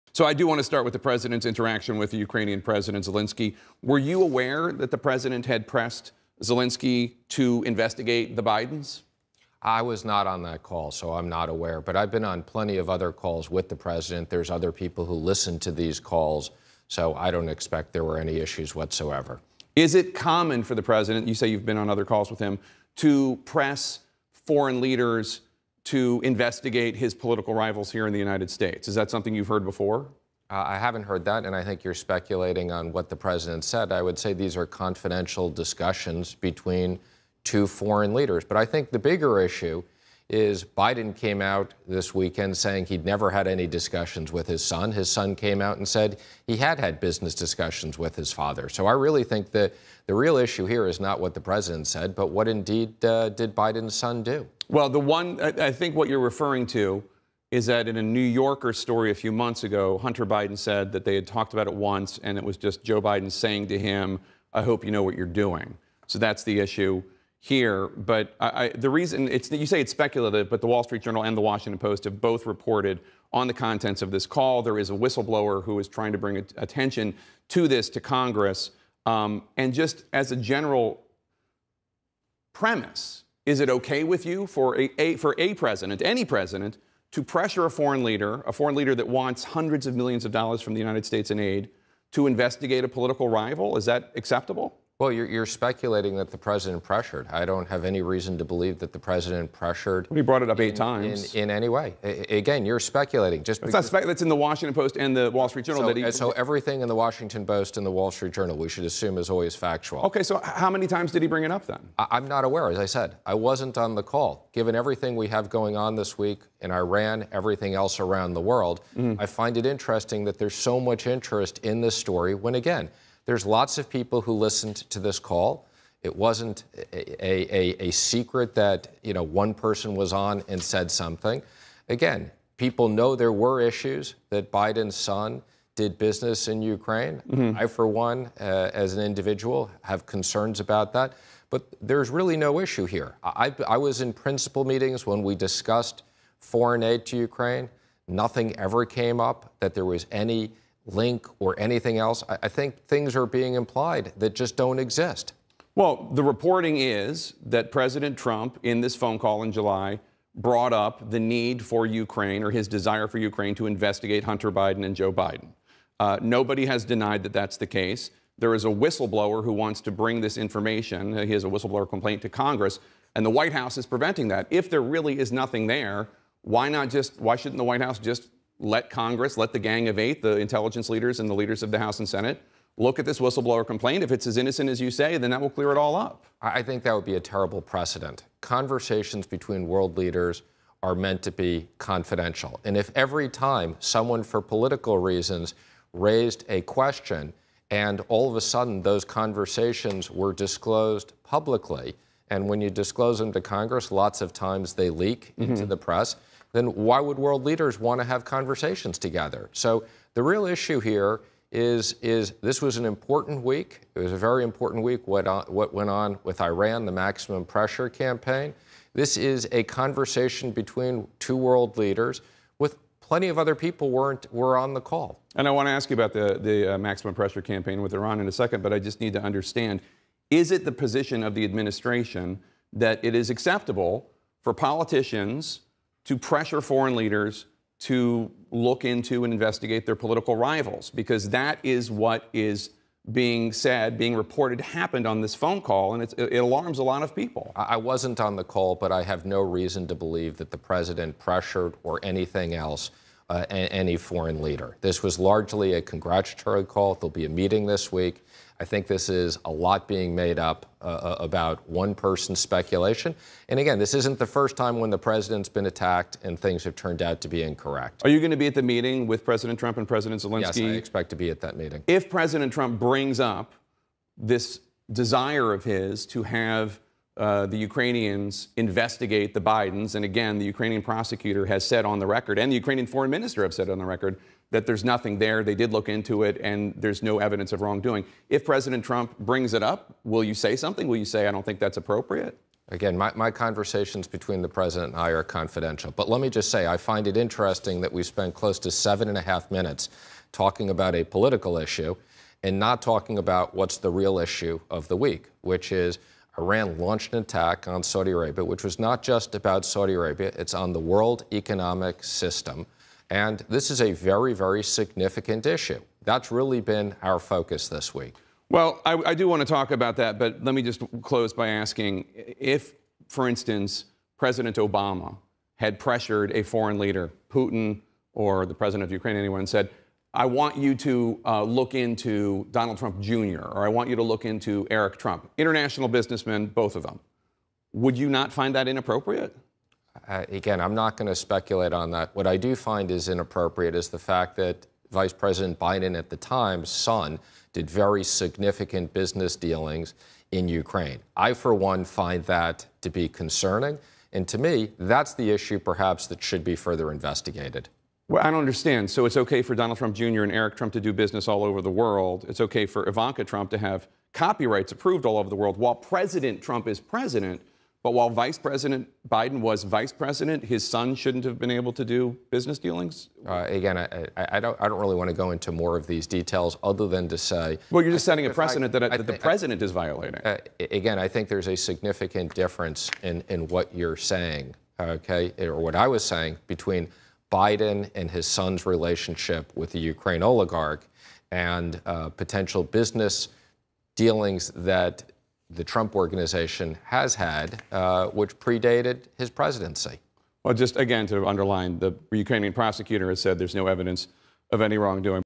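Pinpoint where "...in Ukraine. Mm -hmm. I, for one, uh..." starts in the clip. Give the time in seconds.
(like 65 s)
136 s.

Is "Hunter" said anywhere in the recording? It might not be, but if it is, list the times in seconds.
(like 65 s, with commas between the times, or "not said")
59 s, 164 s.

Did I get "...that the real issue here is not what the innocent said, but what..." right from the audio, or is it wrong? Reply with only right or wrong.
wrong.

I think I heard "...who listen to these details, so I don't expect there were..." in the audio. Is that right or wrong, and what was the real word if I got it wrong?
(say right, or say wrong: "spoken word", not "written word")
wrong: "calls", not "details".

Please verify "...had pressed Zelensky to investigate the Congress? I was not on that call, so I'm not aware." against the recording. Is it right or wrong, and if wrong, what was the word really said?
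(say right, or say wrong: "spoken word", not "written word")
wrong: "Bidens", not "Congress".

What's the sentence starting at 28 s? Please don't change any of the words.
Is that something you've heard before?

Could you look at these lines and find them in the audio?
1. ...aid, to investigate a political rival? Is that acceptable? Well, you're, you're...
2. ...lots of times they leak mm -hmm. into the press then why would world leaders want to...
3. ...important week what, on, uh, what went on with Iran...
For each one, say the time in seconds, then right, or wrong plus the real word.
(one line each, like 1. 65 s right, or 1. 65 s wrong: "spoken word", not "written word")
1. 91 s right
2. 203 s right
3. 214 s right.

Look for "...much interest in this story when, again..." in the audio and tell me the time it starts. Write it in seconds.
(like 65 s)
120 s.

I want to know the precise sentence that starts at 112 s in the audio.
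As I said, I wasn't on the call.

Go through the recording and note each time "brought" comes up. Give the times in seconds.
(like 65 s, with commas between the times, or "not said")
100 s, 160 s.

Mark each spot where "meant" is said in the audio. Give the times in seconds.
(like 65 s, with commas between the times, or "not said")
190 s.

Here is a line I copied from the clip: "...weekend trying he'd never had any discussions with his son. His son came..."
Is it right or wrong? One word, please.
wrong.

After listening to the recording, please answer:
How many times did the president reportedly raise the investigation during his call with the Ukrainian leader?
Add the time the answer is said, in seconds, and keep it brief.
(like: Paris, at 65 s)
8, at 100 s.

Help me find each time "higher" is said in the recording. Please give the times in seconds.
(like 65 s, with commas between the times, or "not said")
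not said.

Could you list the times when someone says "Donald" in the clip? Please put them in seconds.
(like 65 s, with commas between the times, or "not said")
332 s, 359 s.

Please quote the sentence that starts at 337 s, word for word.
Would you not find that inappropriate?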